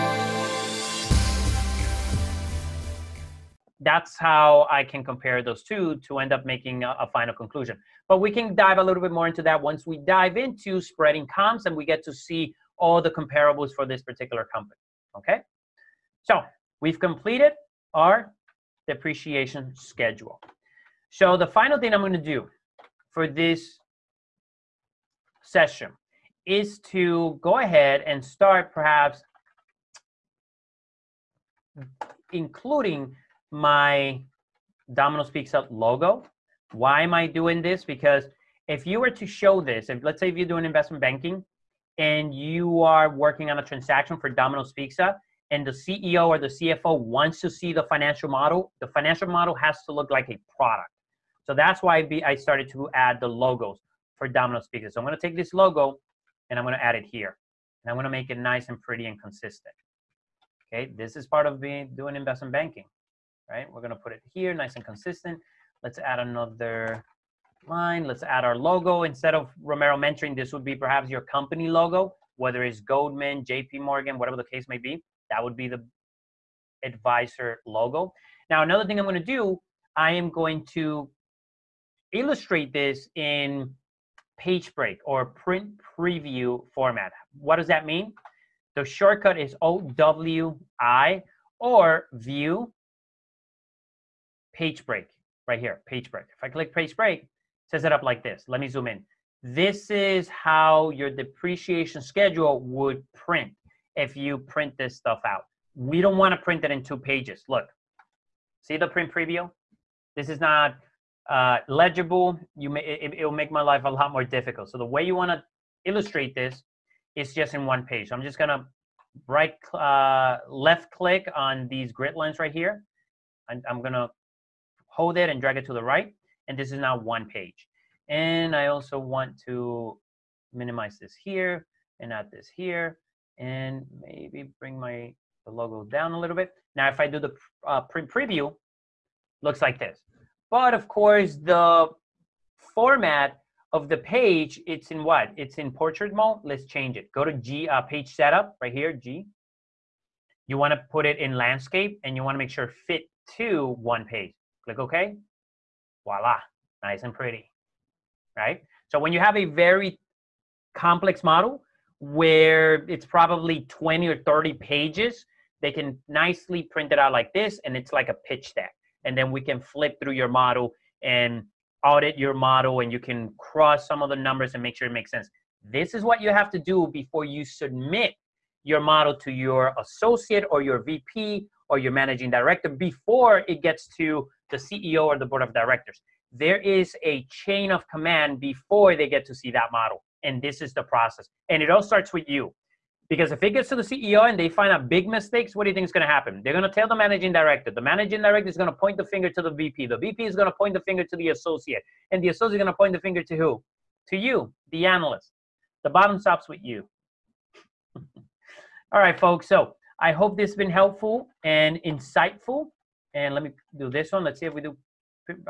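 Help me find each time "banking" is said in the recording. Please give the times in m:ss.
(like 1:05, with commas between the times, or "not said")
0:41, 1:02.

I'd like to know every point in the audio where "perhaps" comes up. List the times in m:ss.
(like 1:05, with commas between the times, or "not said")
0:28, 1:10.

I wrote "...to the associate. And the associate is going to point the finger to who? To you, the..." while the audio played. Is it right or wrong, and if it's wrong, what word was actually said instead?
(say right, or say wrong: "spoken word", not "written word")
right.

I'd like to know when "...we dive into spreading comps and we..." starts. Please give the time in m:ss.
0:09.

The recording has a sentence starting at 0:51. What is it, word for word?
So that's why I started to add the logos for Domino's Pizza.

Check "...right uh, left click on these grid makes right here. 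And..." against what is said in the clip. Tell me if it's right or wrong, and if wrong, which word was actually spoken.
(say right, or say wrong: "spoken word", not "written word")
wrong: "lines", not "makes".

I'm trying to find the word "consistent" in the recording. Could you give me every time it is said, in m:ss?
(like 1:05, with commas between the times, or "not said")
0:59, 1:04.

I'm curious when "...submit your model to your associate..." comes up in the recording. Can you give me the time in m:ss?
2:57.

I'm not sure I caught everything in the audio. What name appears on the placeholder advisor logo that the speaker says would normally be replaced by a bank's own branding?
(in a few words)
Romero Mentoring.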